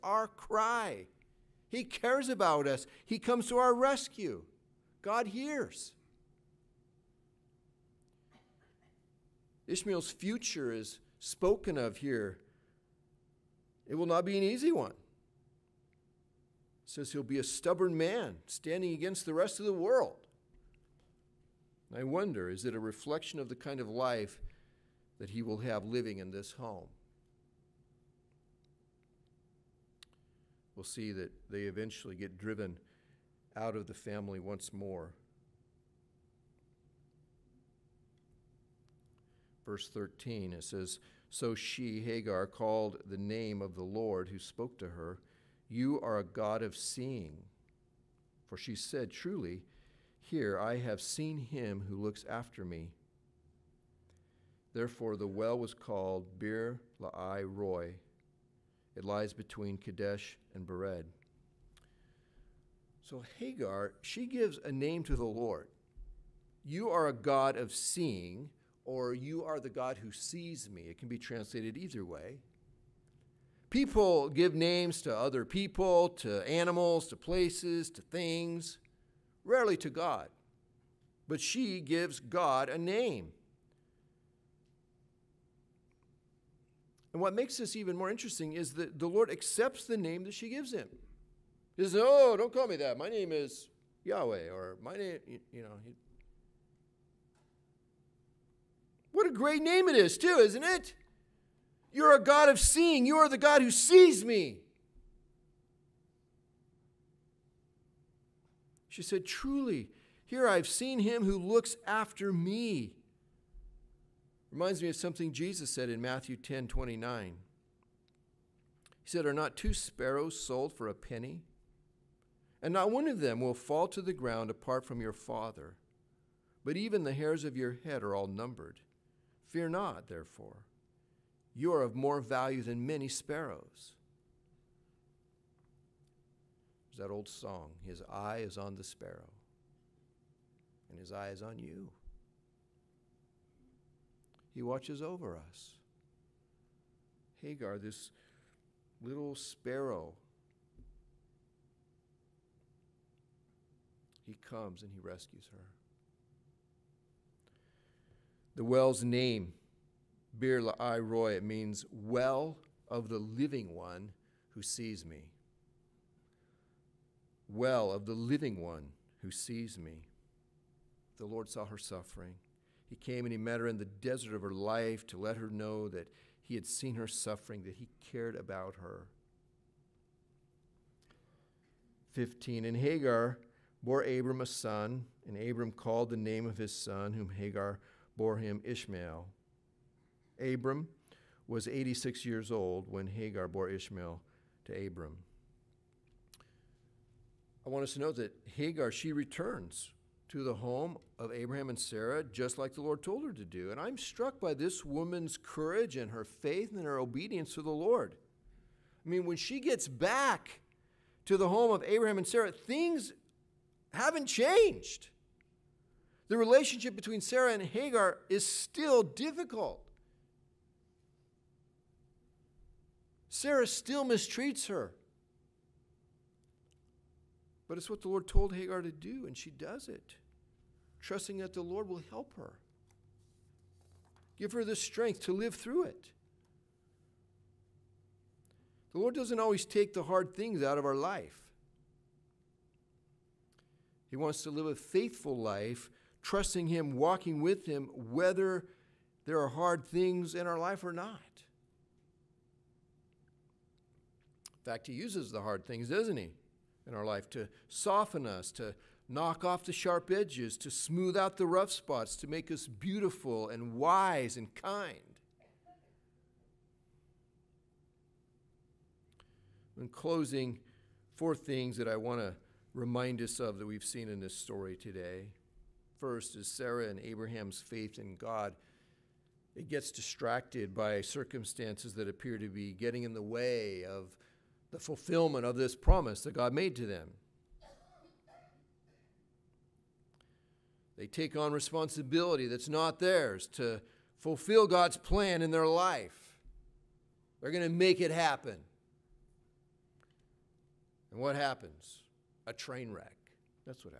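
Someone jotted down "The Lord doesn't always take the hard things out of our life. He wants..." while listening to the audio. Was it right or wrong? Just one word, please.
right.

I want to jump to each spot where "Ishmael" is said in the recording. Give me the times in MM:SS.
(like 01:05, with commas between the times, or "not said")
00:09, 03:08, 03:13.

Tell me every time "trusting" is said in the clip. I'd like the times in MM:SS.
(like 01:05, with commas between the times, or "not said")
03:51, 04:06.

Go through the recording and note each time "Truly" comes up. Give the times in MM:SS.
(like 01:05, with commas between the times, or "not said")
00:49, 01:49.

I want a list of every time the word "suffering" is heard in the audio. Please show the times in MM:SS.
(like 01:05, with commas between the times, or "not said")
02:51, 02:57.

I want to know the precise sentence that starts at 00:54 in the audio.
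Therefore, the well was called Beer Lahai Roi.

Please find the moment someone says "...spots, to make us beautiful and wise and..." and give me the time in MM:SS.
04:21.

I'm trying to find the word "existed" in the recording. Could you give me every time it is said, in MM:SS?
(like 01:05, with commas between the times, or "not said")
not said.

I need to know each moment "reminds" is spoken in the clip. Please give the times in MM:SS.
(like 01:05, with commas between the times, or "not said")
01:54, 04:32.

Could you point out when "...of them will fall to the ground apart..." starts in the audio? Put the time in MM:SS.
02:03.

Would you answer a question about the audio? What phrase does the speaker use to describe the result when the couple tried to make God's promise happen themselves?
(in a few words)
A train wreck.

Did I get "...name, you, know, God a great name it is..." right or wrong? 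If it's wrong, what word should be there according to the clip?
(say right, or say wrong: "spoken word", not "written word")
wrong: "What", not "God".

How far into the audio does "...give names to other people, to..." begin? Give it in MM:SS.
01:14.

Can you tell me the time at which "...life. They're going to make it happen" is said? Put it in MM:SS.
04:55.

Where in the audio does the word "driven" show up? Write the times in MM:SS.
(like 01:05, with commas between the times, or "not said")
00:32.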